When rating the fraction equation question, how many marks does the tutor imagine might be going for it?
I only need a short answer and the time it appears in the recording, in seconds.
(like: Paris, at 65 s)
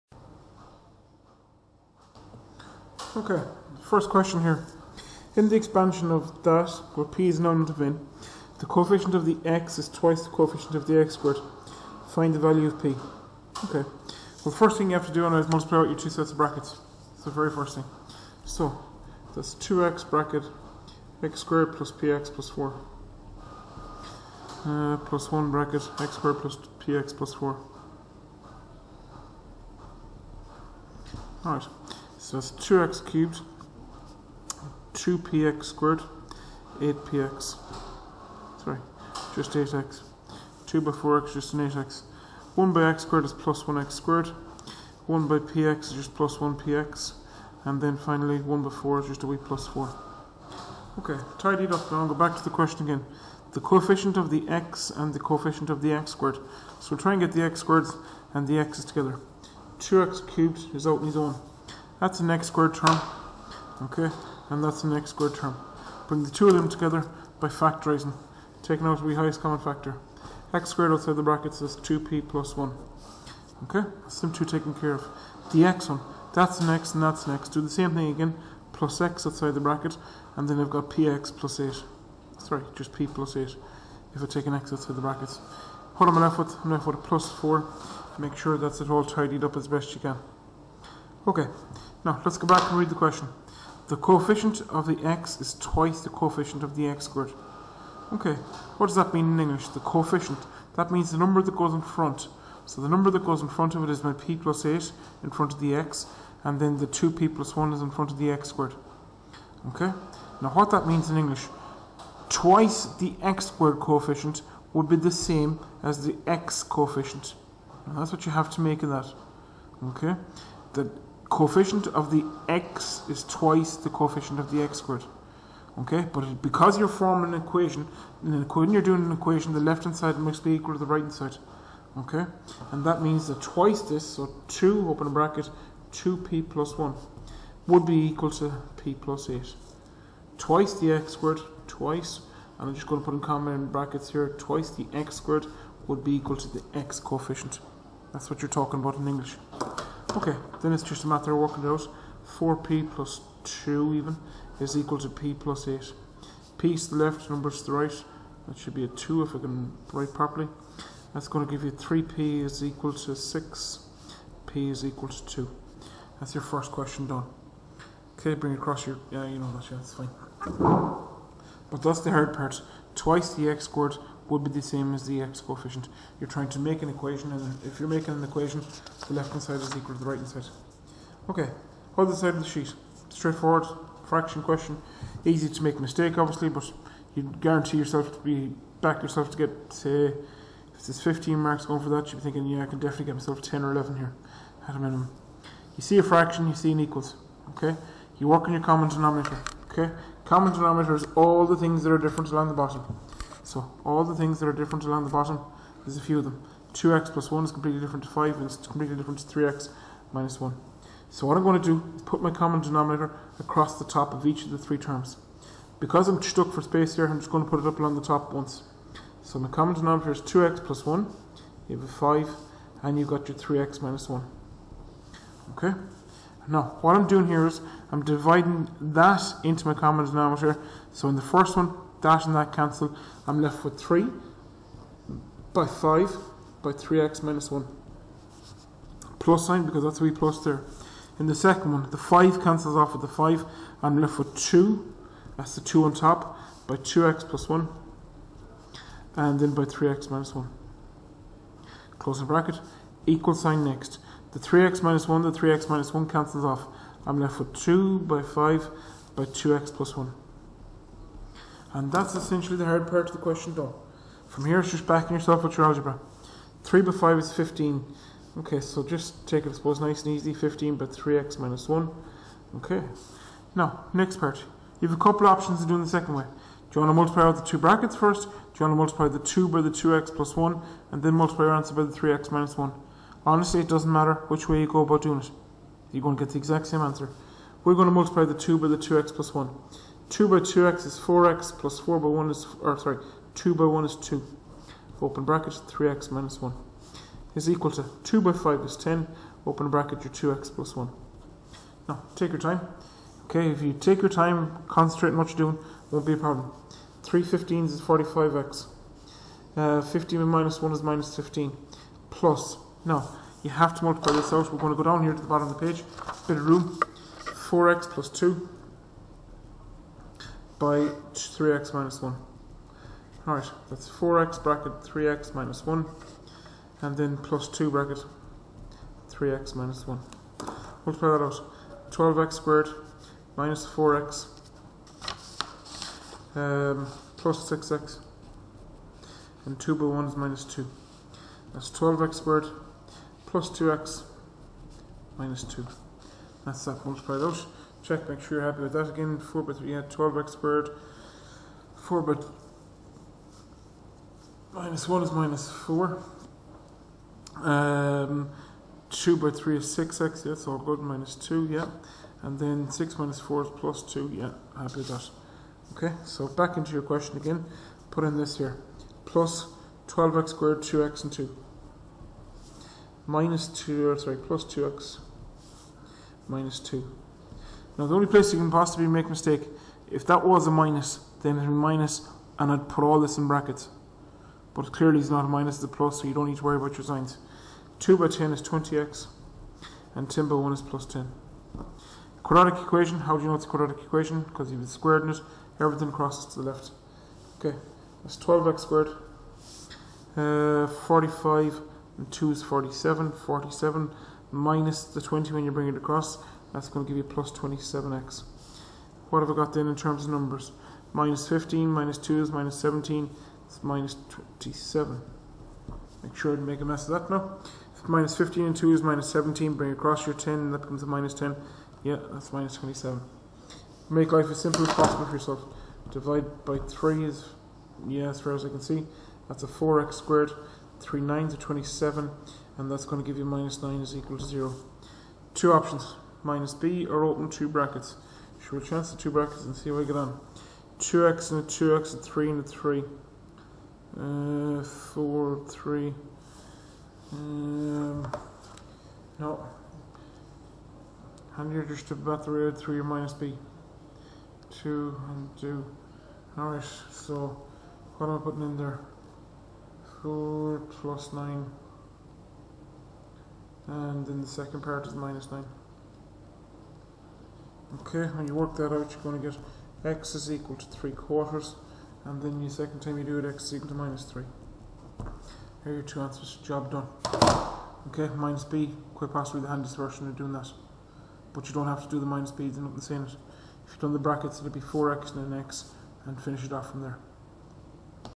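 15, at 191 s.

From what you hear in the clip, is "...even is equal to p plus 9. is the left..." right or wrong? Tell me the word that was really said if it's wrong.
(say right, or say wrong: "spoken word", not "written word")
wrong: "8", not "9".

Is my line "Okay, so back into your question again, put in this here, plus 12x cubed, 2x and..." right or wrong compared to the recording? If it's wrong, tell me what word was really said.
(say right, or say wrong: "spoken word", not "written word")
wrong: "squared", not "cubed".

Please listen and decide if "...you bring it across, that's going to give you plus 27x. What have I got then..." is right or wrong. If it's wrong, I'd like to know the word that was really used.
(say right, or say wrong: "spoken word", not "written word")
right.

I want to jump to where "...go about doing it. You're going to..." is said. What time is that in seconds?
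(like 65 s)
284 s.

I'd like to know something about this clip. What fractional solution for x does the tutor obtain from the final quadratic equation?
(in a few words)
3/4.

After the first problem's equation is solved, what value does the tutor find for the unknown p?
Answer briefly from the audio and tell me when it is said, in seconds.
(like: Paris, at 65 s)
2, at 164 s.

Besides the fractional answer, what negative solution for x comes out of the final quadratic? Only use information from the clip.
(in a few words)
-3.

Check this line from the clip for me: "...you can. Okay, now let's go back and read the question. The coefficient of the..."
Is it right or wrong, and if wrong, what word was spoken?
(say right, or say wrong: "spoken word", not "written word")
right.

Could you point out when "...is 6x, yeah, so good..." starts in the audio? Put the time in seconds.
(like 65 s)
359 s.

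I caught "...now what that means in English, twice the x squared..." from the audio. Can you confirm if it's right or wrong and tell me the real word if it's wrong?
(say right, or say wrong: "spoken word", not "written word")
right.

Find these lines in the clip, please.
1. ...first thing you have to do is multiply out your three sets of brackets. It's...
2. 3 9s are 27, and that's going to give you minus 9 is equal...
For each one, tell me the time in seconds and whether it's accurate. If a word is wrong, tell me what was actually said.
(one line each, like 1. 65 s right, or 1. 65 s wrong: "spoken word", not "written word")
1. 14 s wrong: "two", not "three"
2. 430 s right.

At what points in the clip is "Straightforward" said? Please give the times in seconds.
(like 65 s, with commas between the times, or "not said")
183 s.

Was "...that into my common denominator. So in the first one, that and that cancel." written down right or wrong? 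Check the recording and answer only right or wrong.
right.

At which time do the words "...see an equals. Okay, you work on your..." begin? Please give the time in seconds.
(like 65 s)
196 s.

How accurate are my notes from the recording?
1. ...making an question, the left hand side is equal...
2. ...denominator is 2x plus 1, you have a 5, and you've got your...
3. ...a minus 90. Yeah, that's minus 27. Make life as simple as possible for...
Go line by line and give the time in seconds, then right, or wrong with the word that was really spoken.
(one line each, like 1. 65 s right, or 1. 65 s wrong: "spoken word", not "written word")
1. 177 s wrong: "equation", not "question"
2. 219 s right
3. 420 s wrong: "10", not "90".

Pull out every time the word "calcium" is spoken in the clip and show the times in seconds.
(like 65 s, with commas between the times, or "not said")
not said.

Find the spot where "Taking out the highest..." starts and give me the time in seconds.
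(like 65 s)
68 s.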